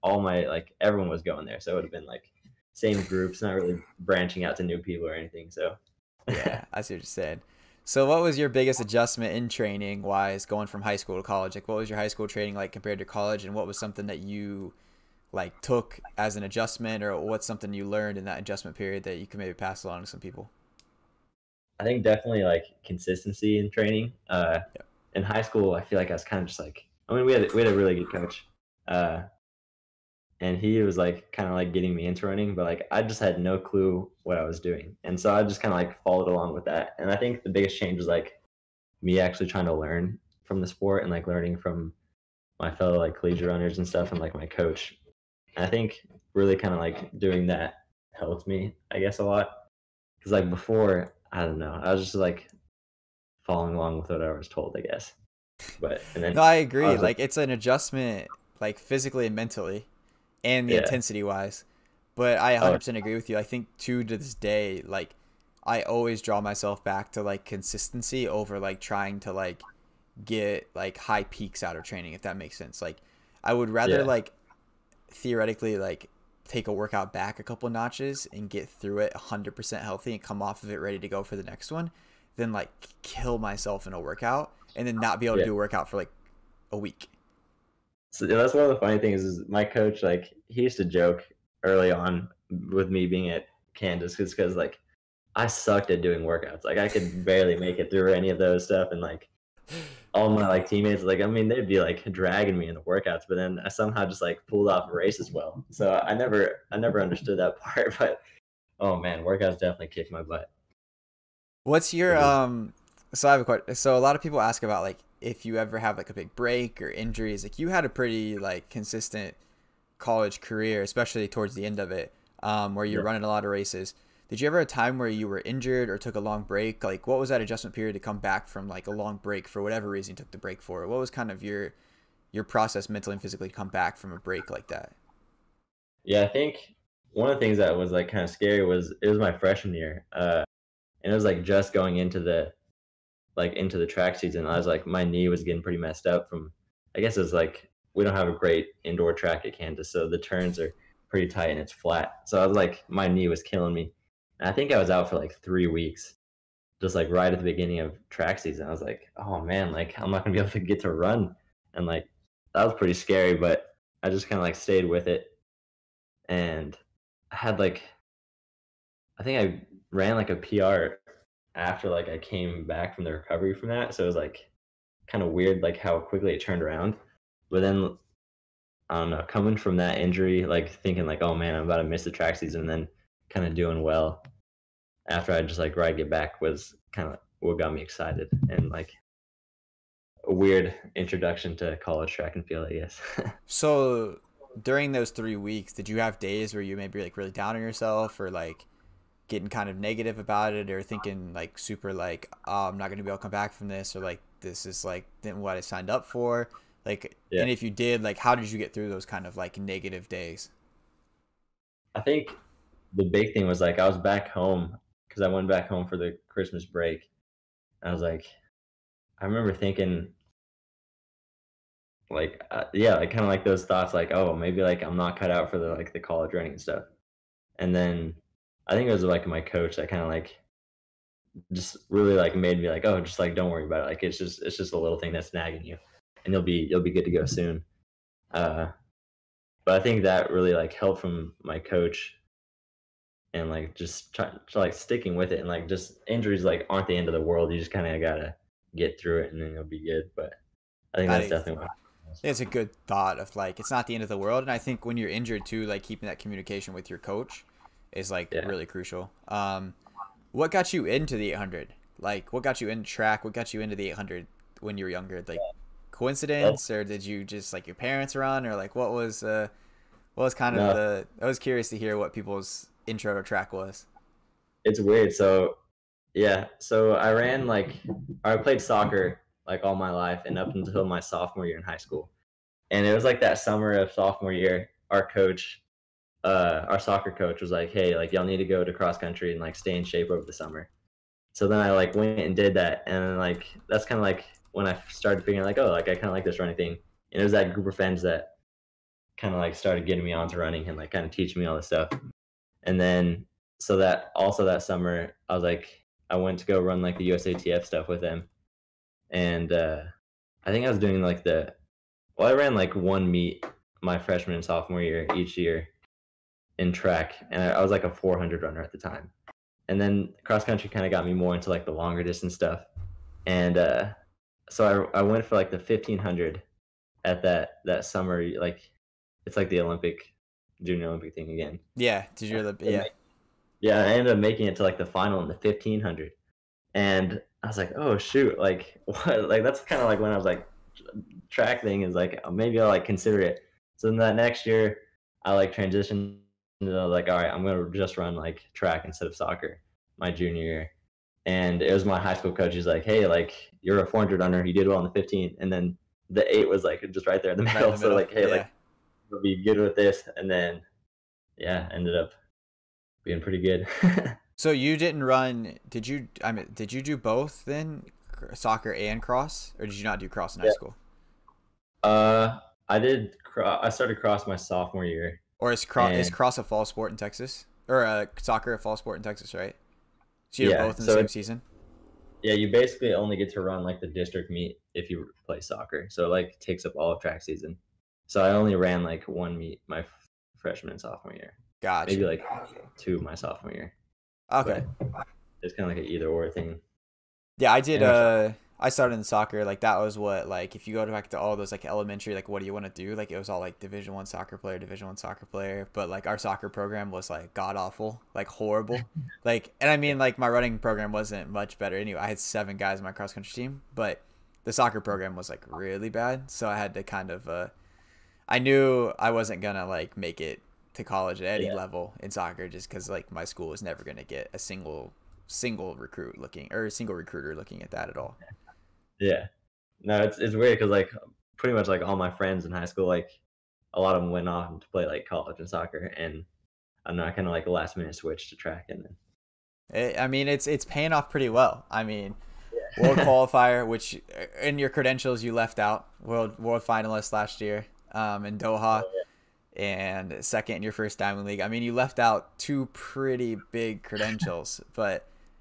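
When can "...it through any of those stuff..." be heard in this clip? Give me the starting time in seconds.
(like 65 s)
97 s.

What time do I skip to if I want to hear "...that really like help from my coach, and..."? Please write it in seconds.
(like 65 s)
240 s.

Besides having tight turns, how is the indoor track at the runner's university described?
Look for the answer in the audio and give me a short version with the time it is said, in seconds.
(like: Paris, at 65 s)
Flat, at 151 s.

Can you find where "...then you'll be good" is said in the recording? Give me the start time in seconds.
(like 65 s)
249 s.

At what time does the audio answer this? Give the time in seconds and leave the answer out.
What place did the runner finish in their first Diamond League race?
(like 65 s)
450 s.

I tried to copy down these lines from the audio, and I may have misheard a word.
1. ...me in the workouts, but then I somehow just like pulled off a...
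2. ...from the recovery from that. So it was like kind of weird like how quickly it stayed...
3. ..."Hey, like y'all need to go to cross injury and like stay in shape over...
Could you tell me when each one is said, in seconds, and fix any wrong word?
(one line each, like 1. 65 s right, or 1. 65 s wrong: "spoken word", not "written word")
1. 102 s right
2. 172 s wrong: "turned", not "stayed"
3. 287 s wrong: "country", not "injury".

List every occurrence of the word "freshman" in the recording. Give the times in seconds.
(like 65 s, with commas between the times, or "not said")
139 s, 313 s, 390 s.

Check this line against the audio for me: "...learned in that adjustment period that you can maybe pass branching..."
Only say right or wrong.
wrong.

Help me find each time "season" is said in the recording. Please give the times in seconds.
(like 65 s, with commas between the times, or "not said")
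144 s, 158 s, 182 s, 381 s, 387 s.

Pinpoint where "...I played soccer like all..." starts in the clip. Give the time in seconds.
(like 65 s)
278 s.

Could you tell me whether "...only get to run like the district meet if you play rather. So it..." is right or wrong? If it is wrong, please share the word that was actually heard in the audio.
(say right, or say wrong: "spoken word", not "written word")
wrong: "soccer", not "rather".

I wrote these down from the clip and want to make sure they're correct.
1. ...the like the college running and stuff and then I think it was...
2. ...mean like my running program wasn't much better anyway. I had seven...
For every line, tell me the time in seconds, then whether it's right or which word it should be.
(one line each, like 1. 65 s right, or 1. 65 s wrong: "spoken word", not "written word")
1. 225 s right
2. 409 s right.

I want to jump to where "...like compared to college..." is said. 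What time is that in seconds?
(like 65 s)
12 s.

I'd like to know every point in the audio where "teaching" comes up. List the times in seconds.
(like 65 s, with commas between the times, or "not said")
301 s.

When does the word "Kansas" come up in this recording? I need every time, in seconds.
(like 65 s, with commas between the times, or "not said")
93 s, 149 s.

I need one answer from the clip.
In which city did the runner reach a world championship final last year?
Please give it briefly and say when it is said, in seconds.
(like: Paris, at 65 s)
Doha, at 448 s.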